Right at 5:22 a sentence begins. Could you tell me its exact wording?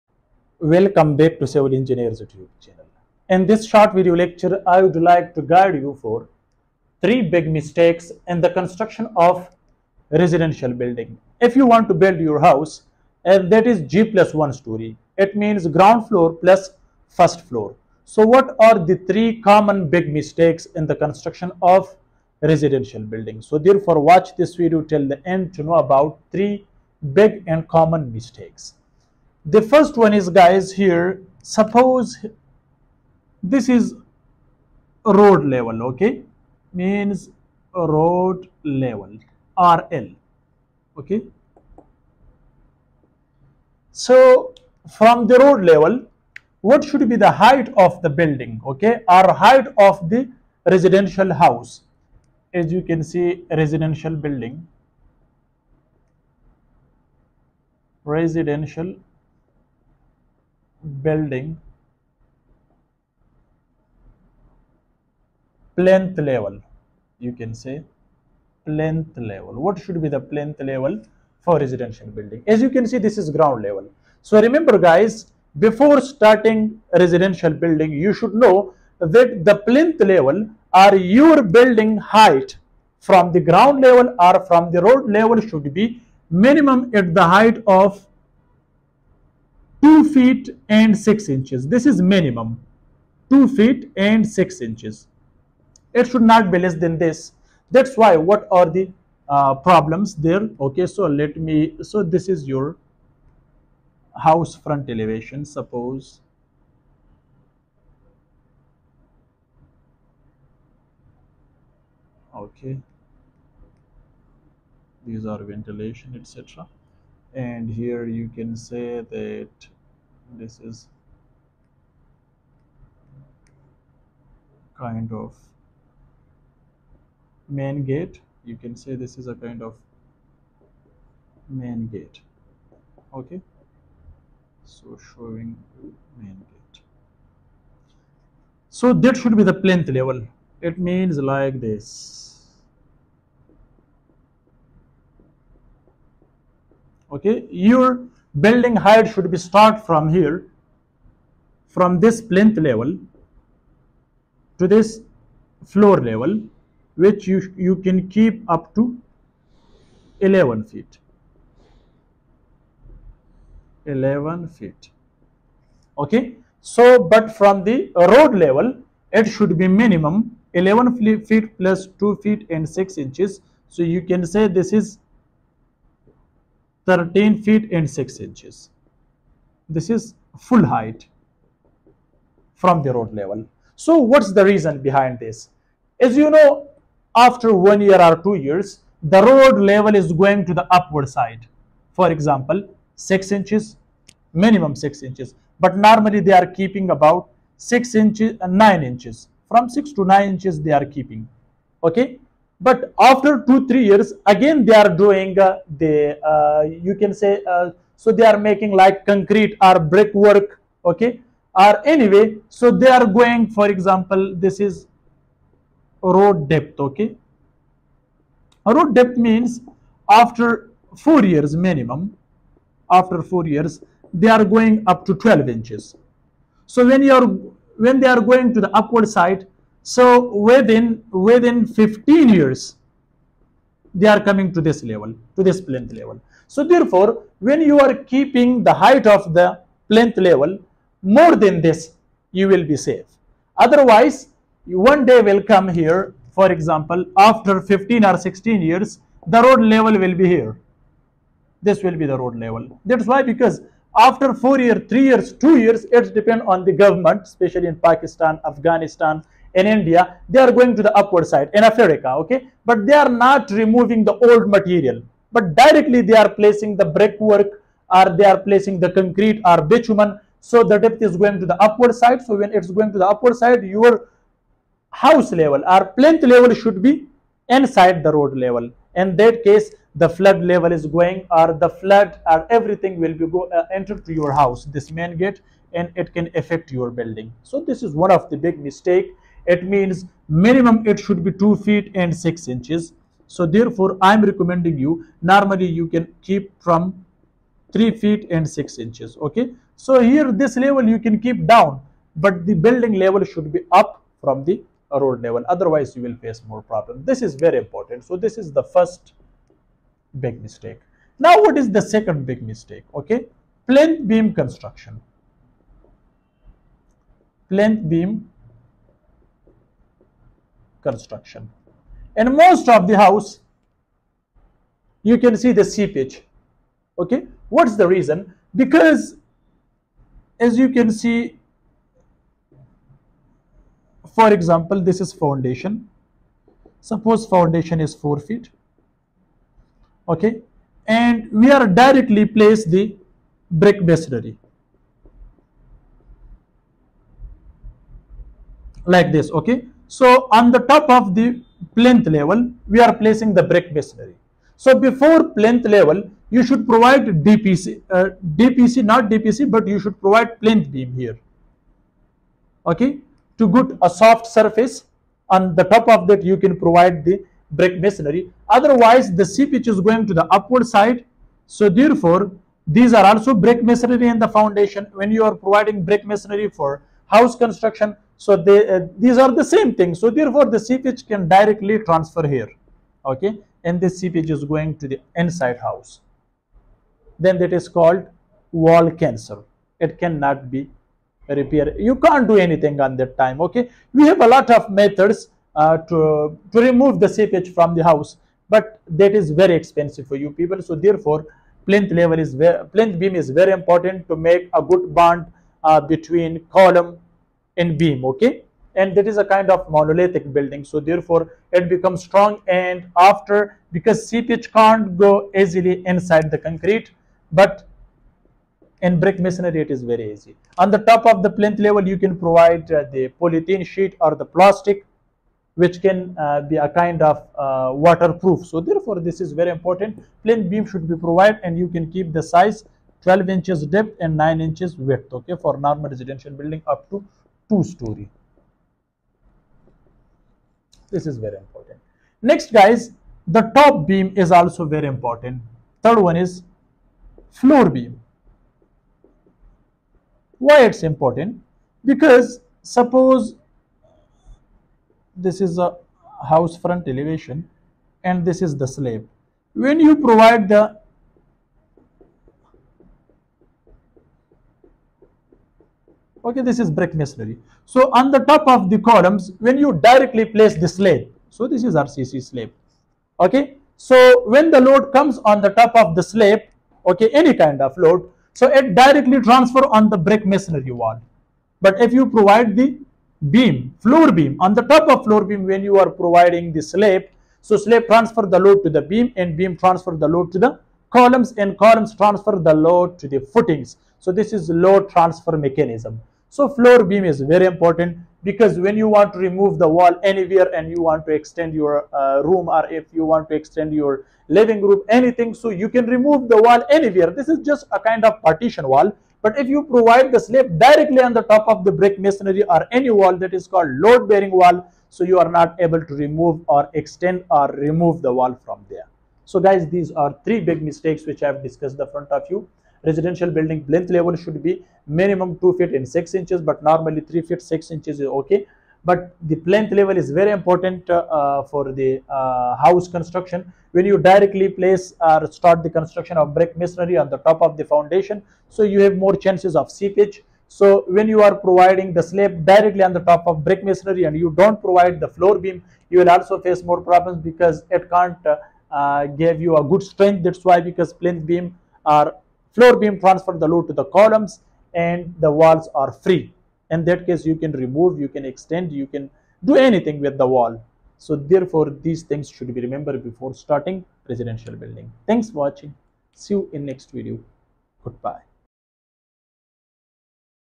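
And most of the house, you can see the seepage.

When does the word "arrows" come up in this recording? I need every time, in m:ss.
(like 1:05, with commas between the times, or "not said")
not said.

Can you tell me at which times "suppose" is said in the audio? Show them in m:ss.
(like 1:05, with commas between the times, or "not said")
0:31, 1:45, 5:36, 7:32.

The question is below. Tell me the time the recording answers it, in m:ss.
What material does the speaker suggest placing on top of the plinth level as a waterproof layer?
7:03.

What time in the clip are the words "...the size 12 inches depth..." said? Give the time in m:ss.
7:12.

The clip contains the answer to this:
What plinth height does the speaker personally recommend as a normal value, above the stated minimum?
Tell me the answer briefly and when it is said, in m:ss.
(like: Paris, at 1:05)
3 feet 6 inches, at 4:57.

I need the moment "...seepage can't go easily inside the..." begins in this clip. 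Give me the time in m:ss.
6:54.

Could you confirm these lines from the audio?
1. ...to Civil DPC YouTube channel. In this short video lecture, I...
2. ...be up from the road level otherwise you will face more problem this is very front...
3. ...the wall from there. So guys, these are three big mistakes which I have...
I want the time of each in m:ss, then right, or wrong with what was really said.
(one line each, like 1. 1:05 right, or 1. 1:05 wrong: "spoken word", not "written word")
1. 0:01 wrong: "Engineers", not "DPC"
2. 5:03 wrong: "important", not "front"
3. 8:38 right.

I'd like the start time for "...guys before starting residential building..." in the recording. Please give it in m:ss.
1:14.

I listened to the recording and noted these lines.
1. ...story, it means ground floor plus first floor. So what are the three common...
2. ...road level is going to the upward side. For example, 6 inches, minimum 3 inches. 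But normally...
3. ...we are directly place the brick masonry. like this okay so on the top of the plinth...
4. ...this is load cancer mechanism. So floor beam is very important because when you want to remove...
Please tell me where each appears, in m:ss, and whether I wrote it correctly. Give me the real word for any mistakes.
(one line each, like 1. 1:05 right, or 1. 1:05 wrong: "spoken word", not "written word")
1. 0:14 right
2. 3:09 wrong: "6", not "3"
3. 5:41 right
4. 8:14 wrong: "transfer", not "cancer".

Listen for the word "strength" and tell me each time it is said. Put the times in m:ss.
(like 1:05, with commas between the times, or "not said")
9:09.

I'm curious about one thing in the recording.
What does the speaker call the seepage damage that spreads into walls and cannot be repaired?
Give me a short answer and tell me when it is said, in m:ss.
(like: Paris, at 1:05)
wall cancer, at 6:28.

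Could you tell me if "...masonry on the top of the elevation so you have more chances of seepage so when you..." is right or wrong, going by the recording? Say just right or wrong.
wrong.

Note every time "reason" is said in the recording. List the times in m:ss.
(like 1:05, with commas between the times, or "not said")
3:04, 5:27.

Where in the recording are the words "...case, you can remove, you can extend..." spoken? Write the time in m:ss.
9:17.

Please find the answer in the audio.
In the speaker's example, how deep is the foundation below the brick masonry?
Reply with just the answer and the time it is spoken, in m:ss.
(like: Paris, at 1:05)
4 feet, at 5:37.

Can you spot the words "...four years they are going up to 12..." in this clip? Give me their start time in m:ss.
3:43.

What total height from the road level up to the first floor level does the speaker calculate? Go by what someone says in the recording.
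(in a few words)
13 feet 6 inches.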